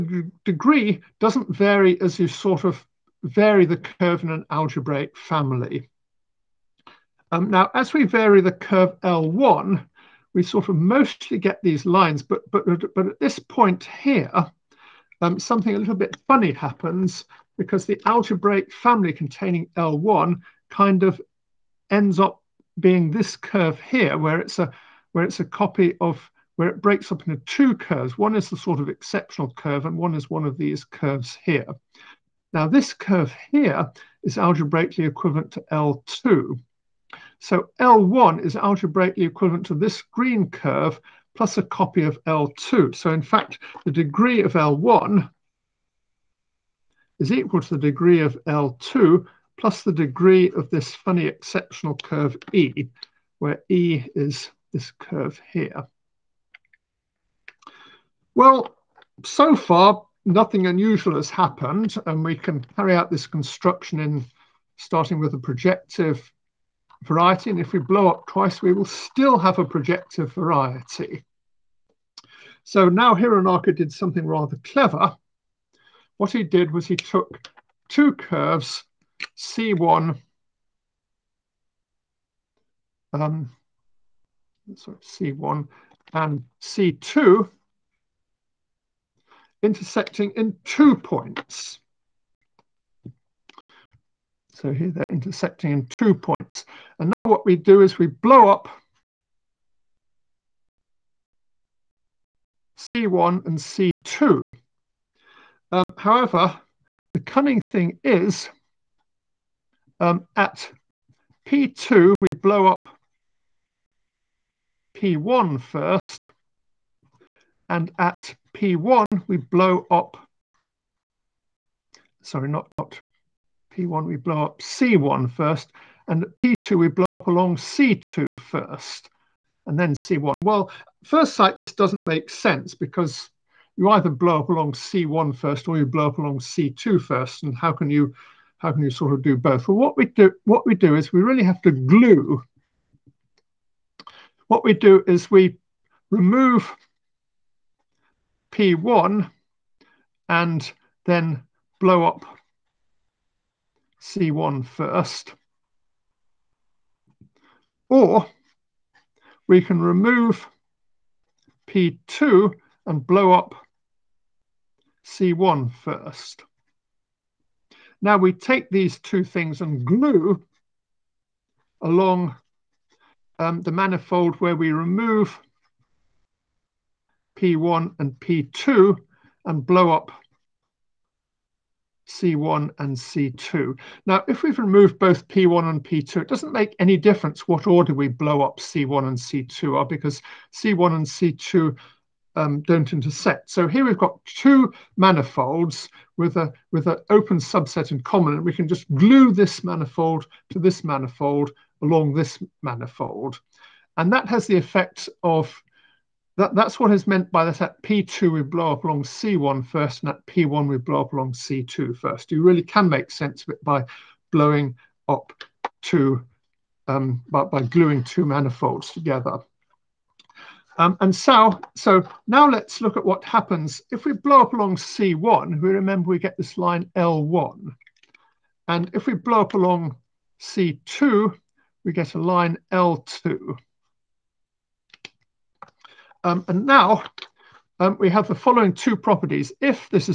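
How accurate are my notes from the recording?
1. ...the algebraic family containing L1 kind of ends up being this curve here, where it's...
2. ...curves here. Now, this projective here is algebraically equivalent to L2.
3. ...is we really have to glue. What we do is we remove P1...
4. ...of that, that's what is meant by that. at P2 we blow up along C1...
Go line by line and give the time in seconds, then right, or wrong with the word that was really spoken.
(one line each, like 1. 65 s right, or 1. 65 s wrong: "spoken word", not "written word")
1. 17 s right
2. 30 s wrong: "curve", not "projective"
3. 140 s right
4. 205 s right.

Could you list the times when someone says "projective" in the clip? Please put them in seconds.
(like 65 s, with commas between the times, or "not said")
65 s, 69 s.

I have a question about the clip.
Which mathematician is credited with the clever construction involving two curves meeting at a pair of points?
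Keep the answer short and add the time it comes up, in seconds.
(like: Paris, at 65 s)
Hironaka, at 73 s.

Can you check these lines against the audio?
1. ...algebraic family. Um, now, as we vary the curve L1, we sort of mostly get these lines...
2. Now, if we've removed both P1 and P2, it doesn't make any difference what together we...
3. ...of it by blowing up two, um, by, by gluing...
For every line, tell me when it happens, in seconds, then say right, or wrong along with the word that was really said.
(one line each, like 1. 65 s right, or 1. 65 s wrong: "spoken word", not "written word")
1. 4 s right
2. 184 s wrong: "order", not "together"
3. 213 s right.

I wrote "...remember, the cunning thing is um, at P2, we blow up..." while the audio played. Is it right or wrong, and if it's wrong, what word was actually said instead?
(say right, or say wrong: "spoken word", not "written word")
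wrong: "however", not "remember".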